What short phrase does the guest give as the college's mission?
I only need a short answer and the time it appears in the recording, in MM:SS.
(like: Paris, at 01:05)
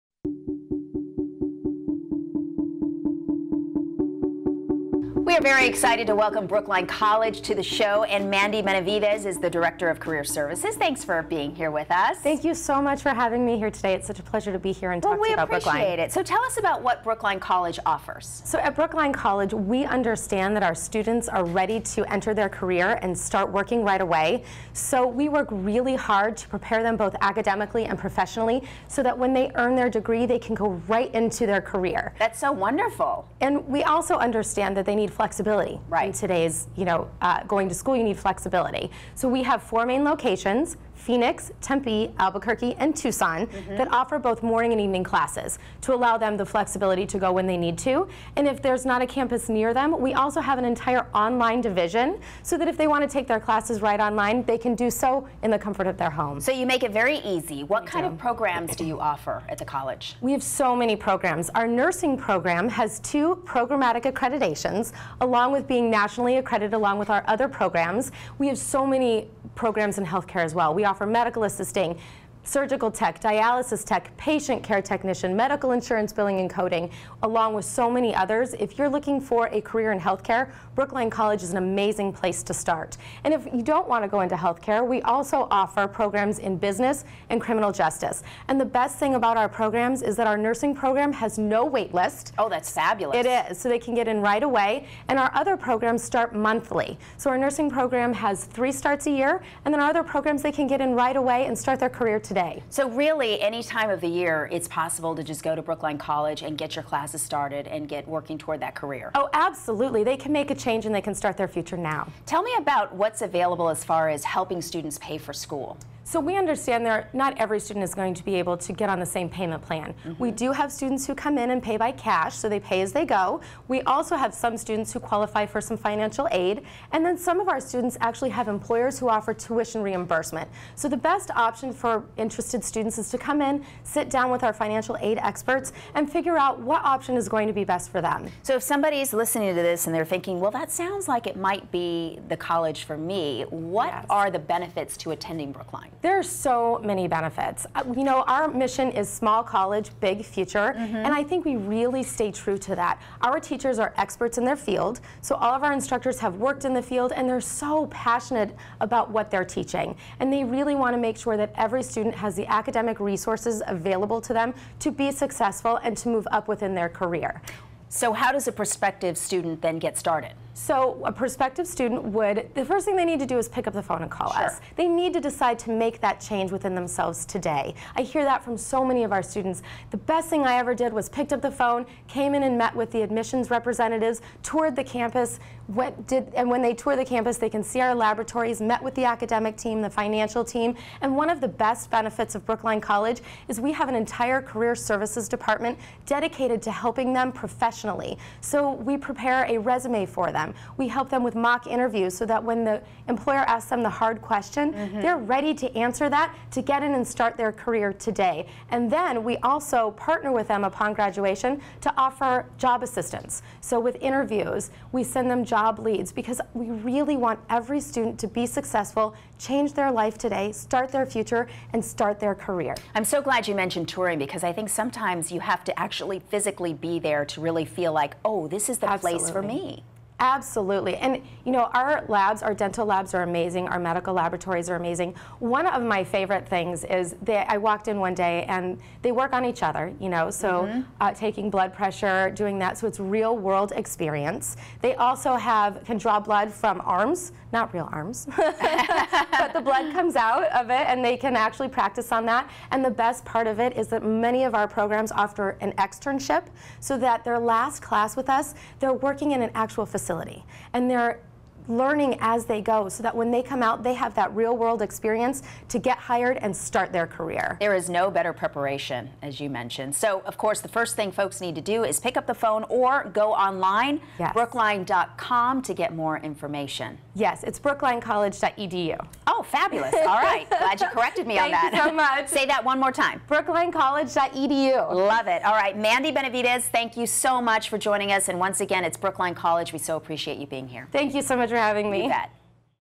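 Small college, big future, at 02:29.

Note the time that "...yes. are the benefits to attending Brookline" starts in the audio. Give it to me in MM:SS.
02:23.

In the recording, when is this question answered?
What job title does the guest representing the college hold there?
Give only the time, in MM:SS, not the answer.
00:09.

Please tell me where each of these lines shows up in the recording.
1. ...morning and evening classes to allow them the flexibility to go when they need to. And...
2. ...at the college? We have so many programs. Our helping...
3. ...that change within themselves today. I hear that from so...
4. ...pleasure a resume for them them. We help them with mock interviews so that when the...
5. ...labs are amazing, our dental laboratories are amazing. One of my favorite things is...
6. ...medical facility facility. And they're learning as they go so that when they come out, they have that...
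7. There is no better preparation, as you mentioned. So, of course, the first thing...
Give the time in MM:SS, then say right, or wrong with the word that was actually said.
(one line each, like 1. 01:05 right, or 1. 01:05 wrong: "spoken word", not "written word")
1. 00:44 right
2. 00:59 wrong: "nursing", not "helping"
3. 02:56 right
4. 03:18 wrong: "prepare", not "pleasure"
5. 03:52 wrong: "medical", not "dental"
6. 04:19 wrong: "actual", not "medical"
7. 04:27 right.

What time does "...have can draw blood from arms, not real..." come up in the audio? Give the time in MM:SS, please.
04:05.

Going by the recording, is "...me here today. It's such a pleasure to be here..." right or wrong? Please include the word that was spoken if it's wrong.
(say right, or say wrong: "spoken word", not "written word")
right.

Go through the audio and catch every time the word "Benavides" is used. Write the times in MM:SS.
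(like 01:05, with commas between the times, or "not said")
00:08, 04:46.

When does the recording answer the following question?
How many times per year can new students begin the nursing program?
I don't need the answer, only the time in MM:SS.
01:38.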